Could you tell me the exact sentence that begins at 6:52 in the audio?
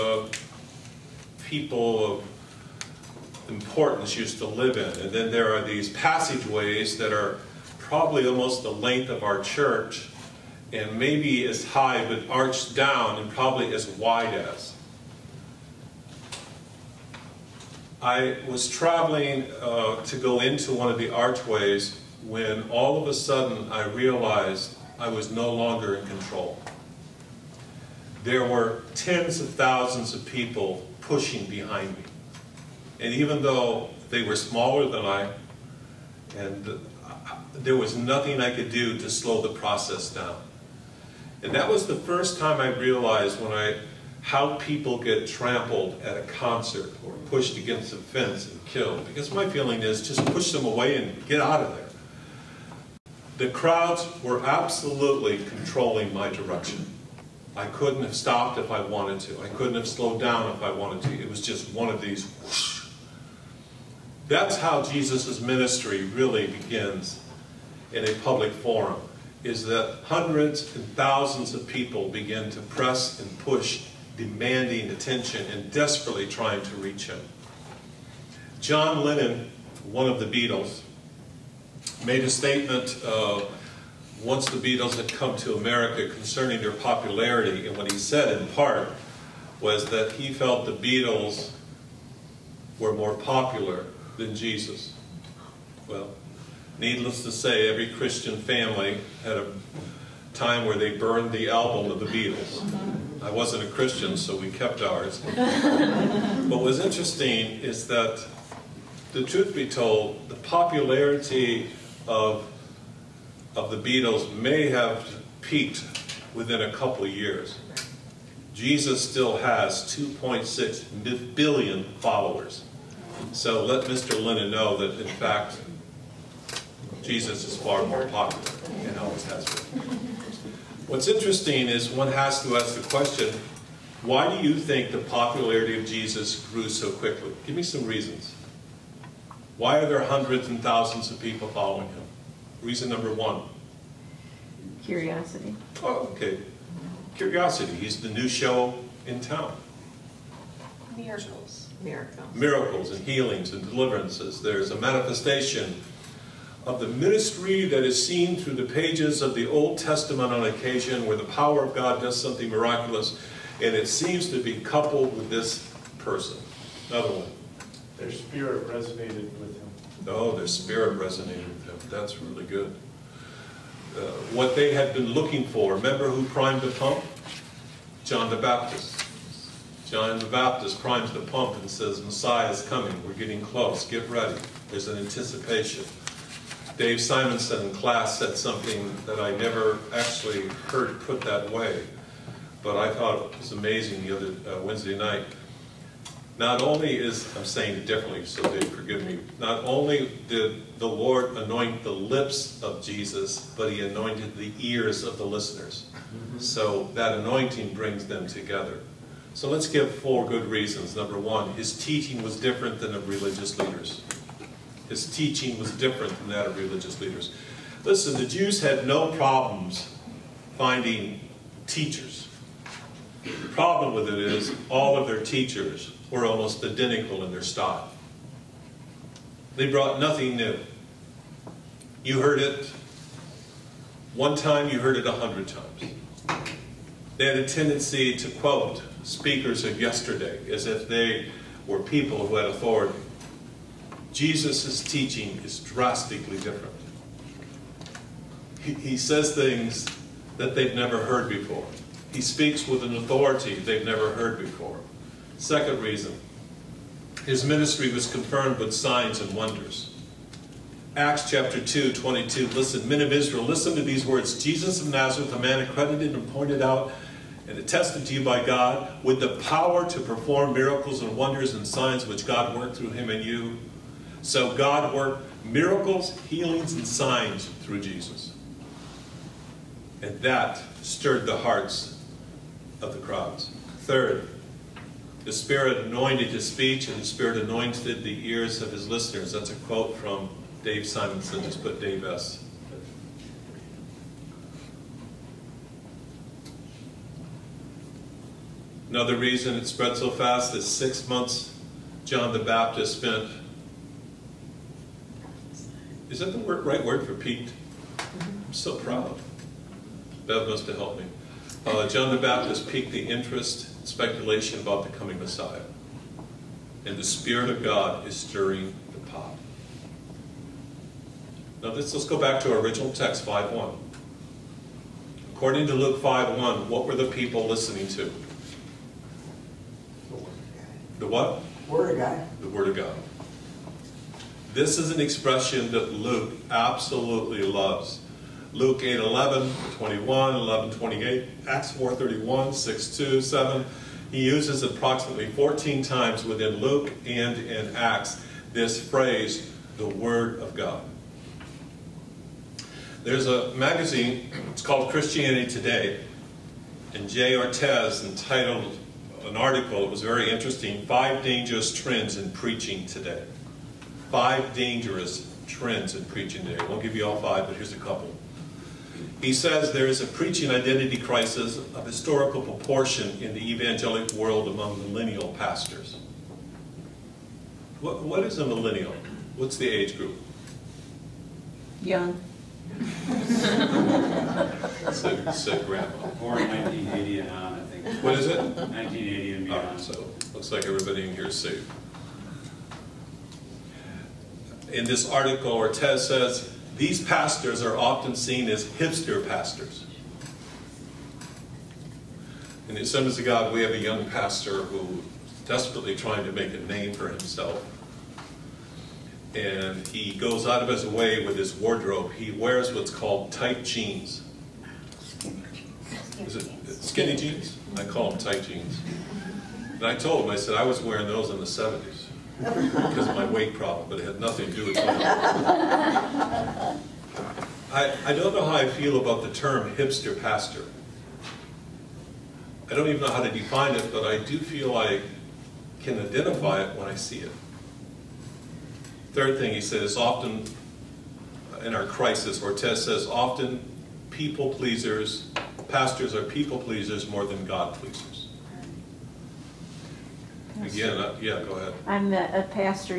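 He wears what's called tight jeans.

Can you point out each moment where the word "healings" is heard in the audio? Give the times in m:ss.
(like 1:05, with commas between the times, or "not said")
2:33, 4:36.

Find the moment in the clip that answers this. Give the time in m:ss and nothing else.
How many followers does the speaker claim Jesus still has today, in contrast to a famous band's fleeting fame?
1:59.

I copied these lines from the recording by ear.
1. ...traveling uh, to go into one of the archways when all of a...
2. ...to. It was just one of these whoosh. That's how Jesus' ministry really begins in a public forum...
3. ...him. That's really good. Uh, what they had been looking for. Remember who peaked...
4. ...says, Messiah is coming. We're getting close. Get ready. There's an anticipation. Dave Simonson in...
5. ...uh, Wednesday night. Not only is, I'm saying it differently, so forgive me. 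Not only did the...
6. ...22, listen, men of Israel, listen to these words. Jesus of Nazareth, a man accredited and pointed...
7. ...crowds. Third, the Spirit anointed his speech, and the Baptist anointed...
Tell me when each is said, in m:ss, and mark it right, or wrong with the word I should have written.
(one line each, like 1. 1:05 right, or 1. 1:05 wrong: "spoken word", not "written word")
1. 0:18 right
2. 1:01 right
3. 2:51 wrong: "primed", not "peaked"
4. 3:01 right
5. 3:14 right
6. 4:21 right
7. 4:43 wrong: "Spirit", not "Baptist".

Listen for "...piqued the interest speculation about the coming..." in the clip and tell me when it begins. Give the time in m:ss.
5:12.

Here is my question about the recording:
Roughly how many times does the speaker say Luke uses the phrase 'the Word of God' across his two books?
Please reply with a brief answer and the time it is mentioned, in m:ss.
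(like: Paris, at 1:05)
14, at 5:45.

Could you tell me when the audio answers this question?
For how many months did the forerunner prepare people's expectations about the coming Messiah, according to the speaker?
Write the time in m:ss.
5:00.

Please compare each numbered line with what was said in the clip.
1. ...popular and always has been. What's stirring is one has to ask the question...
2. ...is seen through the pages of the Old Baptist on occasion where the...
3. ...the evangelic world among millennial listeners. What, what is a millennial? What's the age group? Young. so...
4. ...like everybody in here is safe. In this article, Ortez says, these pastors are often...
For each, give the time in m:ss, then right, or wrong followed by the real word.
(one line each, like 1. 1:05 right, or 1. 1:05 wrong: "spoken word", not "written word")
1. 2:08 wrong: "interesting", not "stirring"
2. 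2:37 wrong: "Testament", not "Baptist"
3. 6:13 wrong: "pastors", not "listeners"
4. 6:30 right.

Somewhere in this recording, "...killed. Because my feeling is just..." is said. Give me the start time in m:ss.
0:48.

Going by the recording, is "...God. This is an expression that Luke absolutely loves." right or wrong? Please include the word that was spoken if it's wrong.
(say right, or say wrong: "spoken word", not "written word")
right.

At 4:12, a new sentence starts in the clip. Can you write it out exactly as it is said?
He speaks with an authority they've never heard before.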